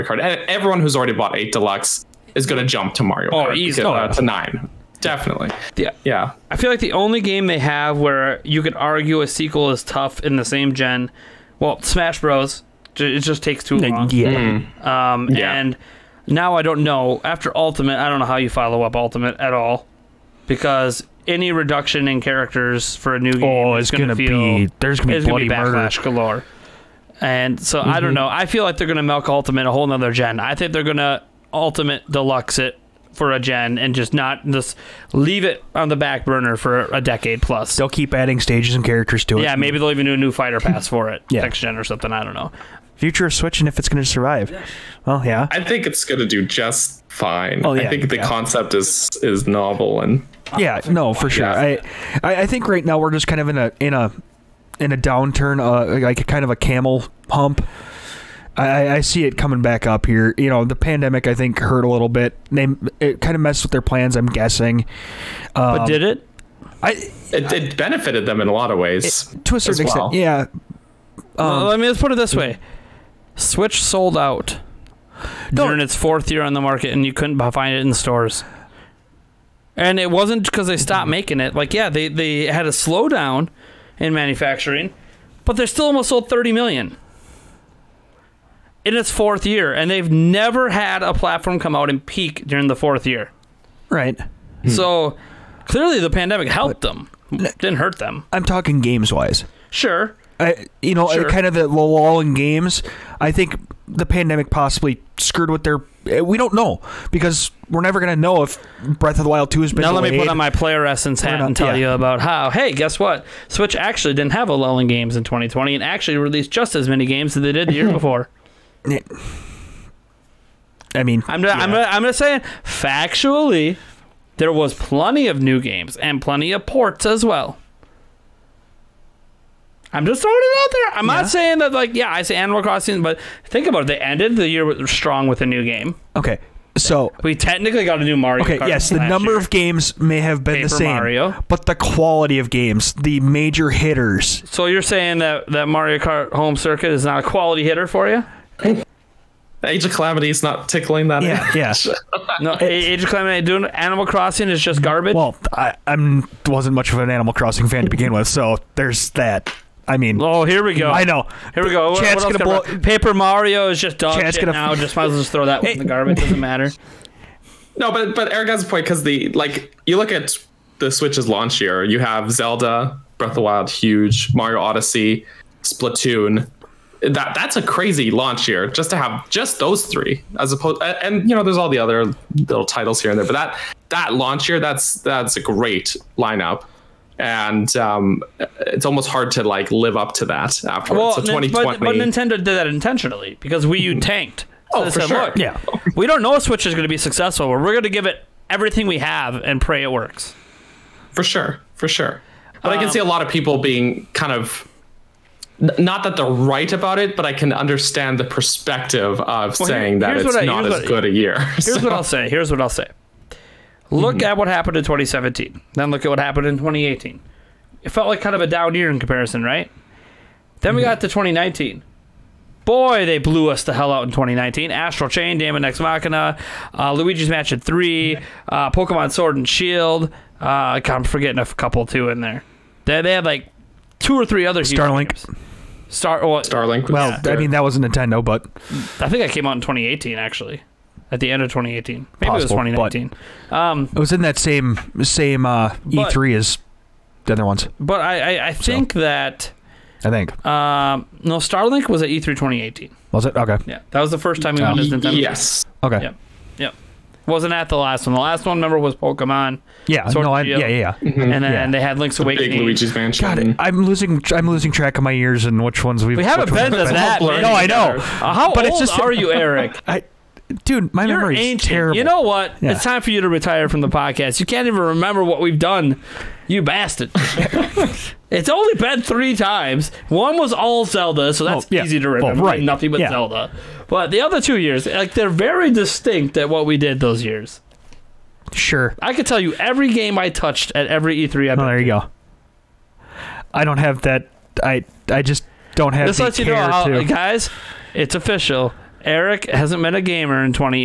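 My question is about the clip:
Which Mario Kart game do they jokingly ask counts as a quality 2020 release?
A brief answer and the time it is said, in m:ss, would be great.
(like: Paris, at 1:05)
Mario Kart Home Circuit, at 2:25.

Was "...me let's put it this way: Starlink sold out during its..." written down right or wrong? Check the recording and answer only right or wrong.
wrong.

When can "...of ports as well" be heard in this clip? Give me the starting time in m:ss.
2:06.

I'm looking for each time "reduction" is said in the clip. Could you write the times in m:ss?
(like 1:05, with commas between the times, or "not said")
0:21.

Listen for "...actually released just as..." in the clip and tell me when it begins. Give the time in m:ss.
1:55.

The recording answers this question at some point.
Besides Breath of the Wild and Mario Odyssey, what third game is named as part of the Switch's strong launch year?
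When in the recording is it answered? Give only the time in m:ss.
2:55.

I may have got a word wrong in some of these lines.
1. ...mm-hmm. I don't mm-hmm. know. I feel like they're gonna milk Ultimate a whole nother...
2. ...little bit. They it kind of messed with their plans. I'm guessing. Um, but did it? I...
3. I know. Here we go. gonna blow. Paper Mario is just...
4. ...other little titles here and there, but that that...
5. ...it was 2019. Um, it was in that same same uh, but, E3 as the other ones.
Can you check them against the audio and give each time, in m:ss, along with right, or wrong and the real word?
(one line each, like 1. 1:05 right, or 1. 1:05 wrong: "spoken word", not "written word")
1. 0:27 right
2. 1:01 right
3. 2:40 right
4. 3:01 right
5. 4:02 right.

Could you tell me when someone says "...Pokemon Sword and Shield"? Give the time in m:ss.
3:48.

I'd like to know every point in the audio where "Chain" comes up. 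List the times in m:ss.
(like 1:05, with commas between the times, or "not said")
3:45.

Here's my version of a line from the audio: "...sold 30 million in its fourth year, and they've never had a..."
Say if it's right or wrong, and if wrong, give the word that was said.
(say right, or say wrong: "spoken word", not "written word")
right.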